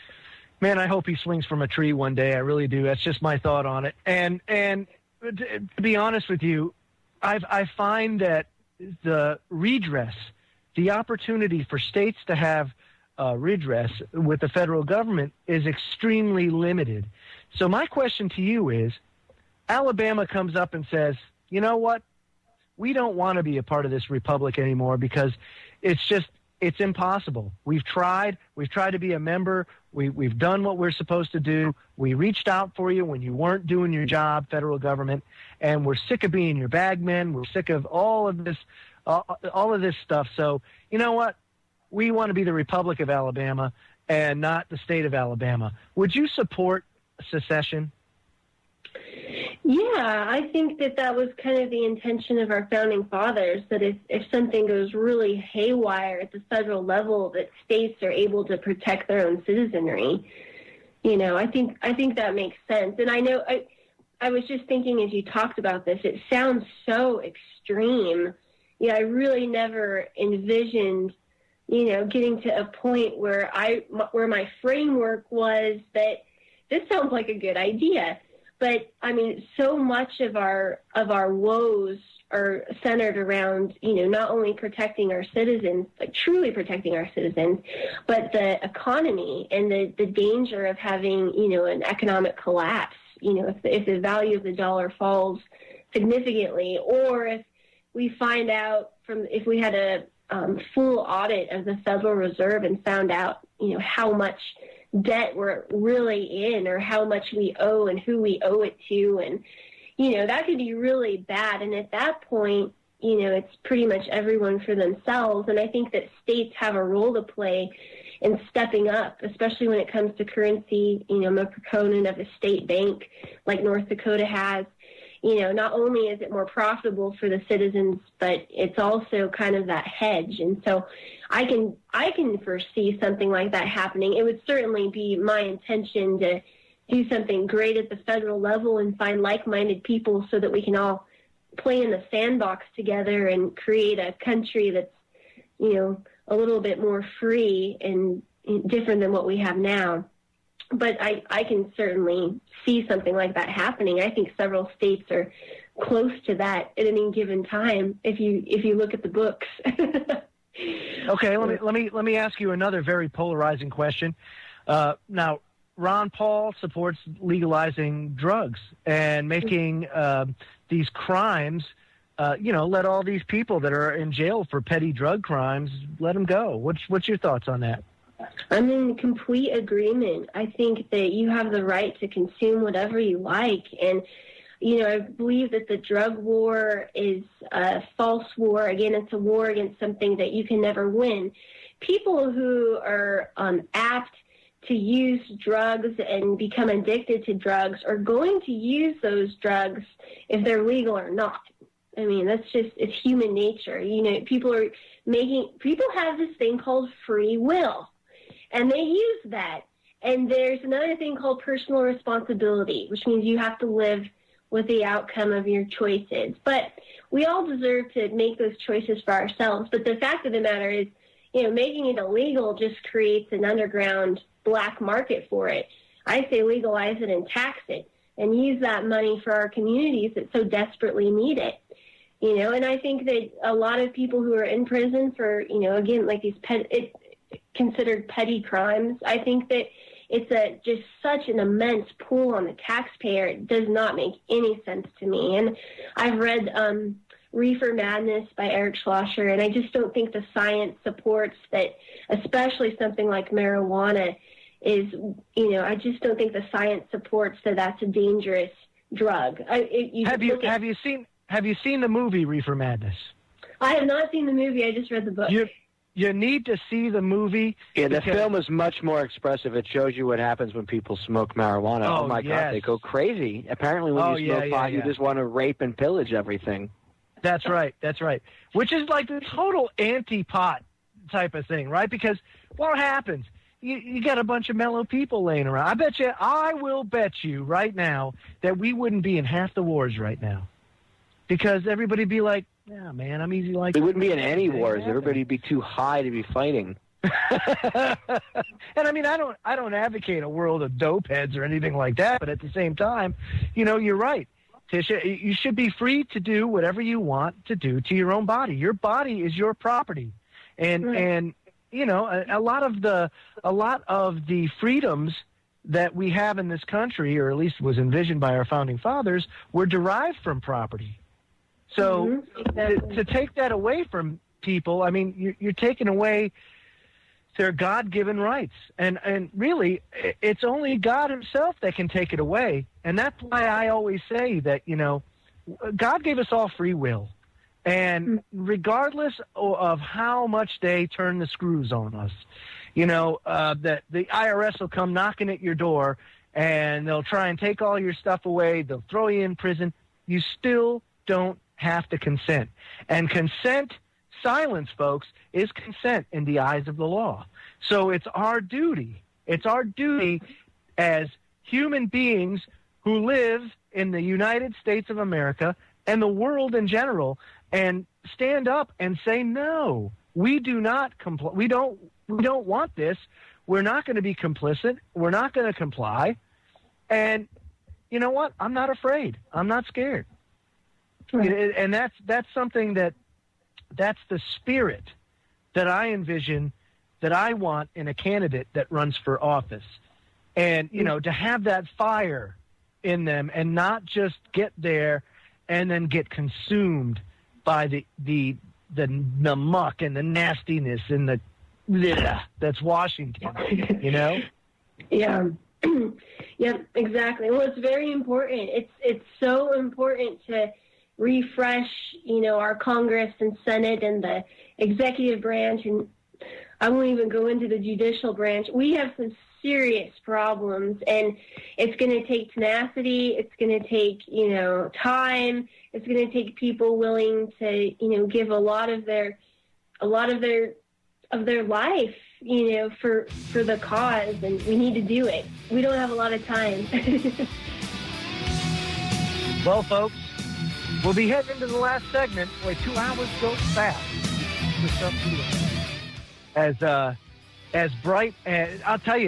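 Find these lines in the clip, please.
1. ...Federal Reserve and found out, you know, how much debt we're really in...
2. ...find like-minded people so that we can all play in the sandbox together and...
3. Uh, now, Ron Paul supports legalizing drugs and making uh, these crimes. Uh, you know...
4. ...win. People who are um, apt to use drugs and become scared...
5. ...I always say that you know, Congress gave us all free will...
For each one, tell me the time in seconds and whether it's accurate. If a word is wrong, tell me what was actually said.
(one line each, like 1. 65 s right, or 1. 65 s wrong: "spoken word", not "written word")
1. 101 s right
2. 138 s right
3. 164 s right
4. 190 s wrong: "addicted", not "scared"
5. 333 s wrong: "God", not "Congress".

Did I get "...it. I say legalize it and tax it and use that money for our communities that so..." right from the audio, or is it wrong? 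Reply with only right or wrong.
right.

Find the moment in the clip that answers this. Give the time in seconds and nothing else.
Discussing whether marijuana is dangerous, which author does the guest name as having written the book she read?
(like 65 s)
248 s.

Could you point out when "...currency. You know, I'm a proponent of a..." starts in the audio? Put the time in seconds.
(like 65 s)
120 s.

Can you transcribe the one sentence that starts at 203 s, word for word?
You know, people are making, people have this thing called free will and they use that.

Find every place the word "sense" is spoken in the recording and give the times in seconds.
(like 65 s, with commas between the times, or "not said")
62 s, 244 s.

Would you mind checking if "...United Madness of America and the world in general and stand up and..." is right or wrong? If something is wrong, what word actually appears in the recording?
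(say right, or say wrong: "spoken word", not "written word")
wrong: "States", not "Madness".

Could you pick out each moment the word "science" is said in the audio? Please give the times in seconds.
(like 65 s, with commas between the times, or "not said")
250 s, 256 s.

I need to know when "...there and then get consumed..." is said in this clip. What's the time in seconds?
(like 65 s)
394 s.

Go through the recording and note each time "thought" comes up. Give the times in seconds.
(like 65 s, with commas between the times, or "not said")
3 s, 177 s.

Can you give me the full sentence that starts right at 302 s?
But at the same time, you know, you're right, Tisha.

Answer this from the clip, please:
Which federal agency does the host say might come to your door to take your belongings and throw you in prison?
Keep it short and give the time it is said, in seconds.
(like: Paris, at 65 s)
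IRS, at 344 s.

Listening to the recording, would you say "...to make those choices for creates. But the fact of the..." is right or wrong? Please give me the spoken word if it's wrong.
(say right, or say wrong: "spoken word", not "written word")
wrong: "ourselves", not "creates".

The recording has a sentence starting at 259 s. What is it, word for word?
I, it, you have you at, have you seen have you seen the movie Reefer Madness?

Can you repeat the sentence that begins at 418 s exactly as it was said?
We have some serious problems, and it's going to take tenacity.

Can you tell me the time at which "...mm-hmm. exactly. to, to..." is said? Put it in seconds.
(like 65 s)
322 s.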